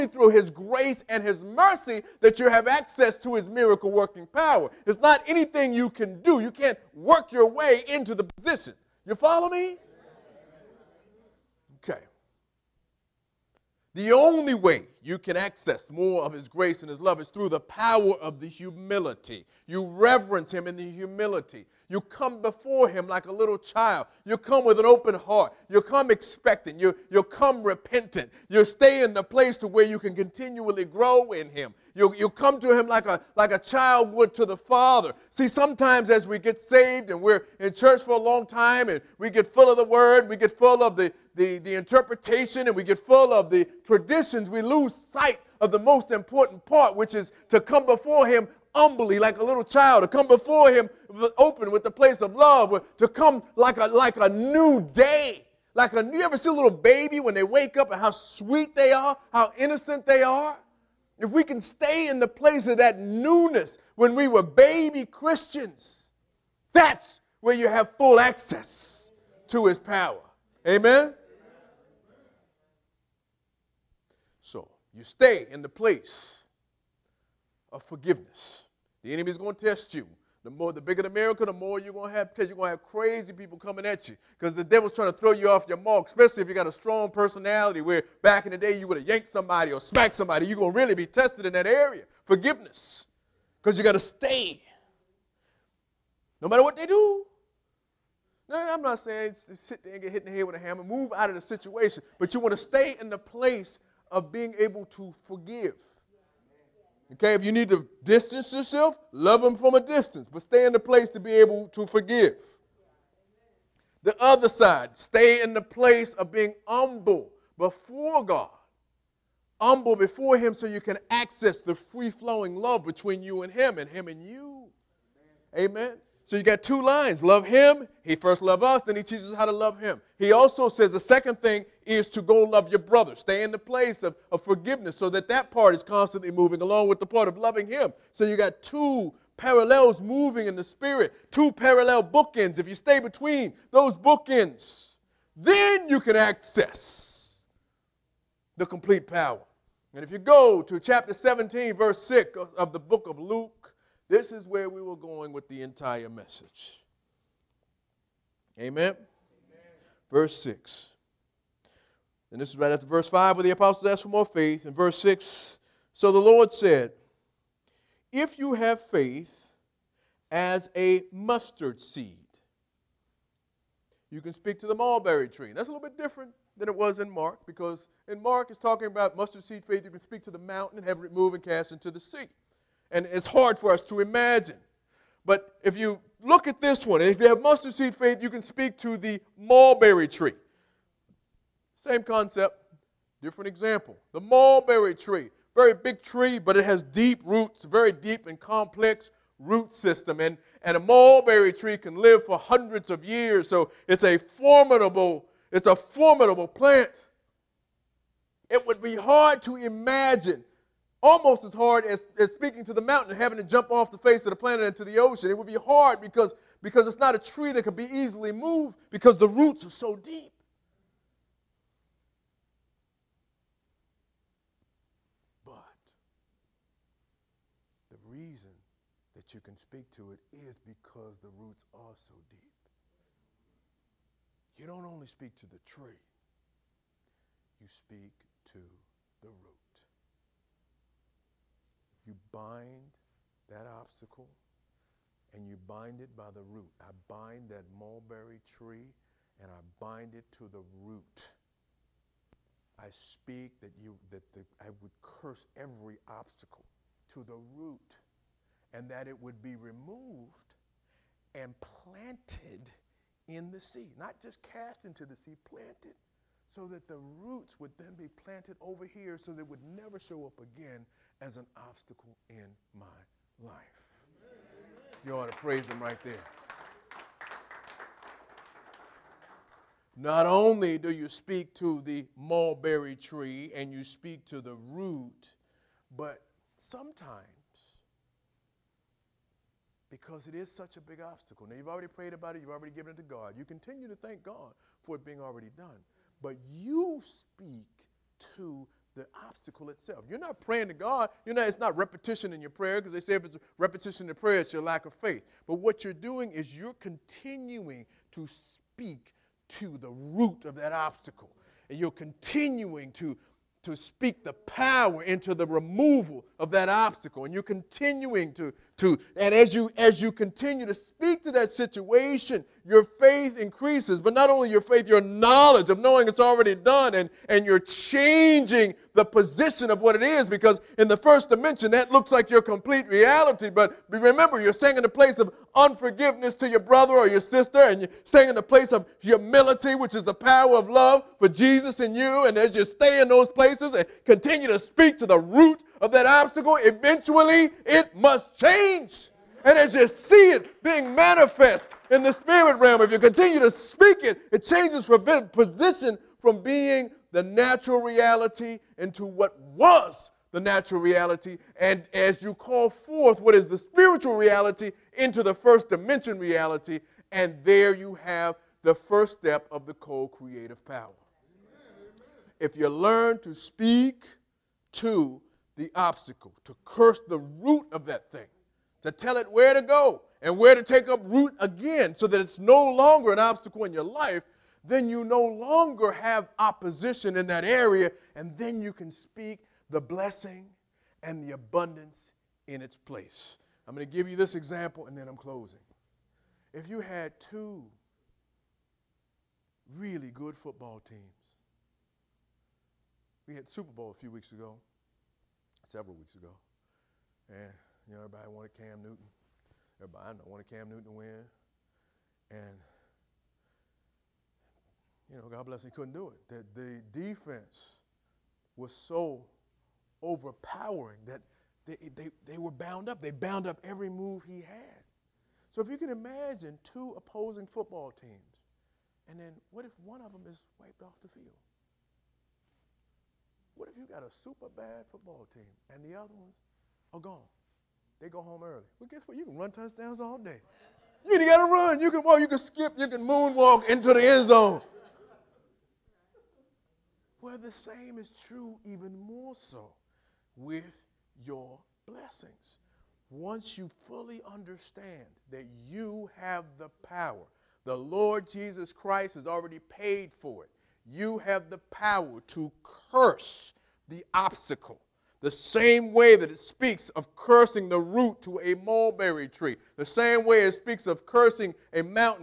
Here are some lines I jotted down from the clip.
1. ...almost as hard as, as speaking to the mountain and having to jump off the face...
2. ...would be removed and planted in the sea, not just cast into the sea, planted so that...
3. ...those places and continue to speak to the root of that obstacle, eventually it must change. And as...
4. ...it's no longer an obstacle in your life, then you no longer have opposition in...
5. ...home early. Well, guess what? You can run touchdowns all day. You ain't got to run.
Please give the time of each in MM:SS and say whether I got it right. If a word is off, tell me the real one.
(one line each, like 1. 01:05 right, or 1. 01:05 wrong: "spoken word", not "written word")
1. 03:31 right
2. 04:19 right
3. 05:43 right
4. 06:22 right
5. 07:18 right.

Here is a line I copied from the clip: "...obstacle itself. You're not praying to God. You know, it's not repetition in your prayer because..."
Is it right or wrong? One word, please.
right.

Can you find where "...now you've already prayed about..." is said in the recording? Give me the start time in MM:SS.
04:51.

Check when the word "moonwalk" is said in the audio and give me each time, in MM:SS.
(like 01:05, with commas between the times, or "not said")
07:23.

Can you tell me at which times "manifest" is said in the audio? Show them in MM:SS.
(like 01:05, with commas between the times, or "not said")
05:50.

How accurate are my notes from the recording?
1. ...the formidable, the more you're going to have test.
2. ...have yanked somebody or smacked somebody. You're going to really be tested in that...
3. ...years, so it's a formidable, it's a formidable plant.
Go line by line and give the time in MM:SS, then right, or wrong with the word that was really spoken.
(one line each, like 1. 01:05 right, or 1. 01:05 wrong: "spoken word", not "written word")
1. 01:21 wrong: "miracle", not "formidable"
2. 01:28 right
3. 03:23 right.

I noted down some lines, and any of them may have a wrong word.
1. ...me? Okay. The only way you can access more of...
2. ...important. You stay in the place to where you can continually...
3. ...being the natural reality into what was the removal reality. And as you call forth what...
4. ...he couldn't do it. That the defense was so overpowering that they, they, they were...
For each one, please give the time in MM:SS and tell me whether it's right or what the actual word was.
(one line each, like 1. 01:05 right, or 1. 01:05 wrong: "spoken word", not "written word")
1. 00:09 right
2. 00:27 wrong: "repentant", not "important"
3. 05:56 wrong: "natural", not "removal"
4. 06:55 right.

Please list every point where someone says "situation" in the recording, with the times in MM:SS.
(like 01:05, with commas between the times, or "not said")
01:41, 05:21.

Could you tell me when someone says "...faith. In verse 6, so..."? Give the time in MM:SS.
02:44.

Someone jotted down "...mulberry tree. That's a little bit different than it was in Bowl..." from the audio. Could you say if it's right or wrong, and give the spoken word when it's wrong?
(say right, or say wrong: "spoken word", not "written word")
wrong: "Mark", not "Bowl".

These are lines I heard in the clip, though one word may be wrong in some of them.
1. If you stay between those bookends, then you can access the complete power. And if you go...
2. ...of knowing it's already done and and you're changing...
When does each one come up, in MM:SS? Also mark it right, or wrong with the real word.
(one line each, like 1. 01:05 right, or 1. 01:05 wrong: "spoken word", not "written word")
1. 02:22 right
2. 05:25 right.